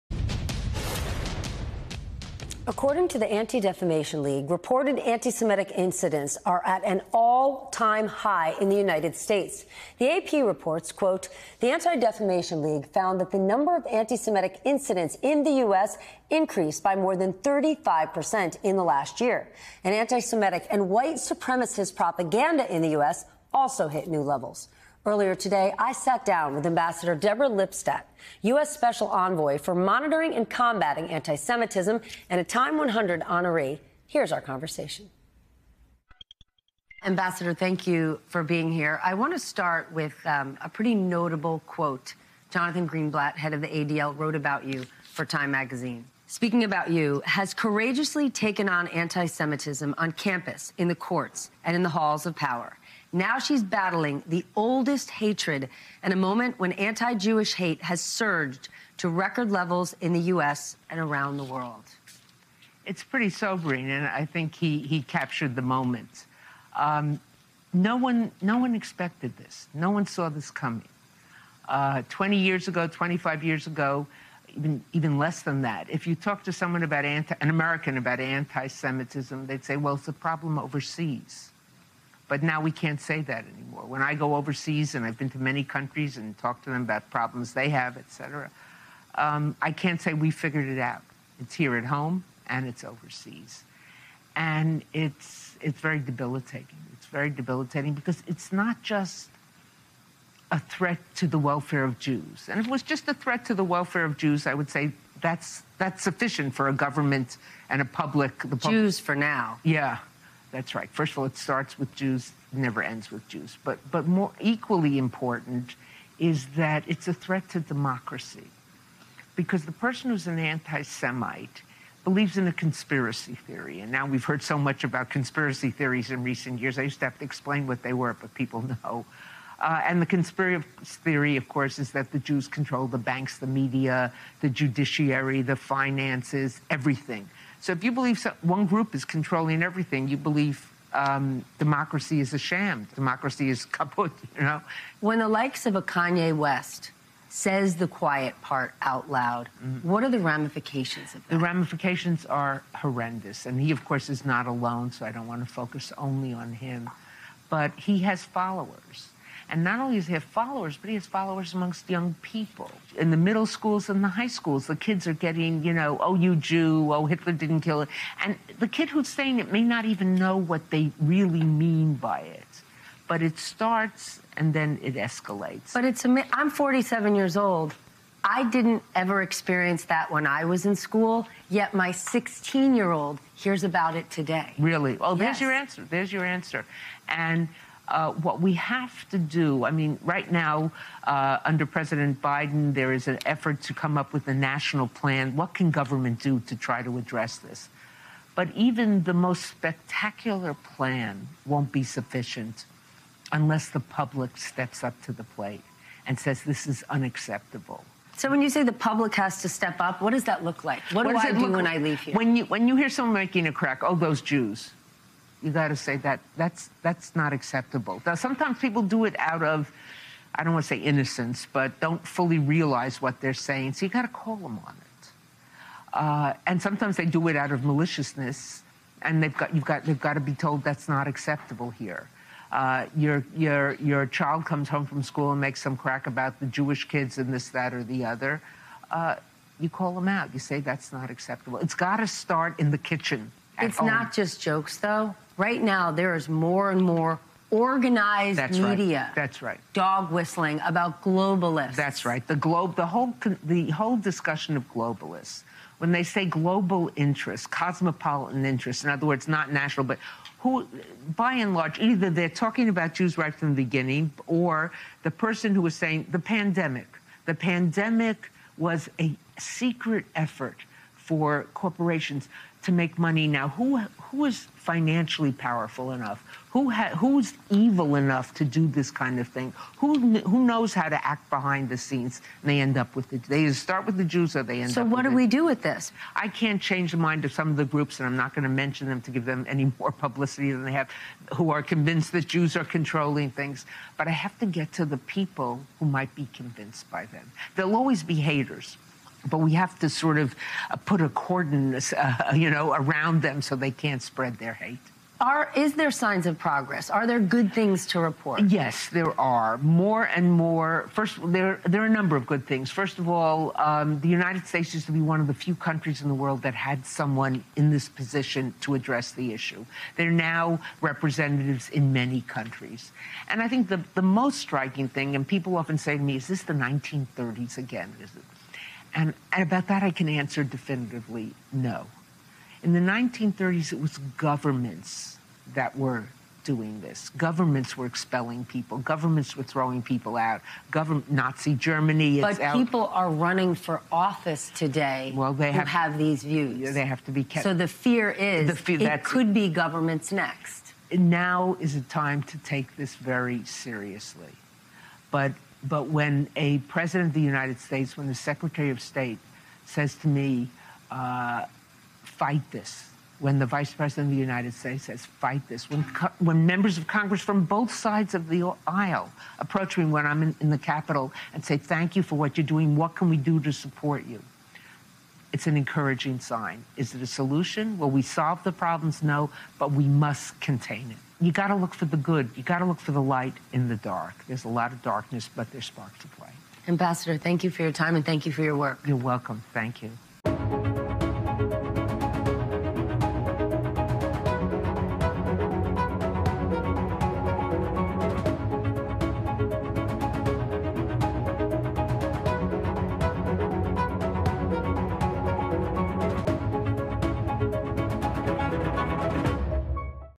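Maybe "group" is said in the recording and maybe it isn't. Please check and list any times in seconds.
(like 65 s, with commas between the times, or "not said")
138 s, 287 s.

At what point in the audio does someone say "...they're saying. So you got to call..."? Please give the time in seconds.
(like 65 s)
223 s.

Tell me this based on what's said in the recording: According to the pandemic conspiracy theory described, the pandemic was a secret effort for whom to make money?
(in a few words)
Corporations.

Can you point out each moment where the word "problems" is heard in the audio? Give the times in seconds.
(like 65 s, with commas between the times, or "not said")
80 s, 87 s, 378 s.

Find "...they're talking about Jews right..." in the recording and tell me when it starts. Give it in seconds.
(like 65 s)
262 s.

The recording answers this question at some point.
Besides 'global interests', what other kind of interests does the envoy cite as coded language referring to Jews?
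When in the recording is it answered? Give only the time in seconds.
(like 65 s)
257 s.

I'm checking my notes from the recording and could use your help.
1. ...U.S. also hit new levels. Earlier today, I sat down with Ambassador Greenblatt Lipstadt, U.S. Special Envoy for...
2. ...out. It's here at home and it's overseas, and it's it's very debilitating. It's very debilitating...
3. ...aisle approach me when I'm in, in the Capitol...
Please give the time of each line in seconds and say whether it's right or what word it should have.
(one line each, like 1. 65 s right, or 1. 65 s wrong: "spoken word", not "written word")
1. 22 s wrong: "Deborah", not "Greenblatt"
2. 90 s right
3. 368 s right.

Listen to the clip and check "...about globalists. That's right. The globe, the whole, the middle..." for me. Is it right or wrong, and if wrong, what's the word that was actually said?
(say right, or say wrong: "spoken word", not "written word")
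wrong: "whole", not "middle".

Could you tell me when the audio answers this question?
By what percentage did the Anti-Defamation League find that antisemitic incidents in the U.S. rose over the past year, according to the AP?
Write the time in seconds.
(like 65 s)
16 s.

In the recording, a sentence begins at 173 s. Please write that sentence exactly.
But it starts and then it escalates.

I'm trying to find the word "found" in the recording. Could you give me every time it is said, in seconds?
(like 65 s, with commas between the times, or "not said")
12 s.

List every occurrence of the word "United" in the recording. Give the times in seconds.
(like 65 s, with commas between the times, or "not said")
8 s, 314 s, 357 s, 364 s.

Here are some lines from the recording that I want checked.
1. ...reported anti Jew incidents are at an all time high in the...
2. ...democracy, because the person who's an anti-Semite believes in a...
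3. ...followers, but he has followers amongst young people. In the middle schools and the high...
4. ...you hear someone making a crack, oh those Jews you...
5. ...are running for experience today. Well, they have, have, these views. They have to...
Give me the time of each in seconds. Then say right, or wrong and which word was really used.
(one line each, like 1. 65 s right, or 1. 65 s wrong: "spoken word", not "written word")
1. 4 s wrong: "Semitic", not "Jew"
2. 117 s right
3. 160 s right
4. 212 s right
5. 342 s wrong: "office", not "experience".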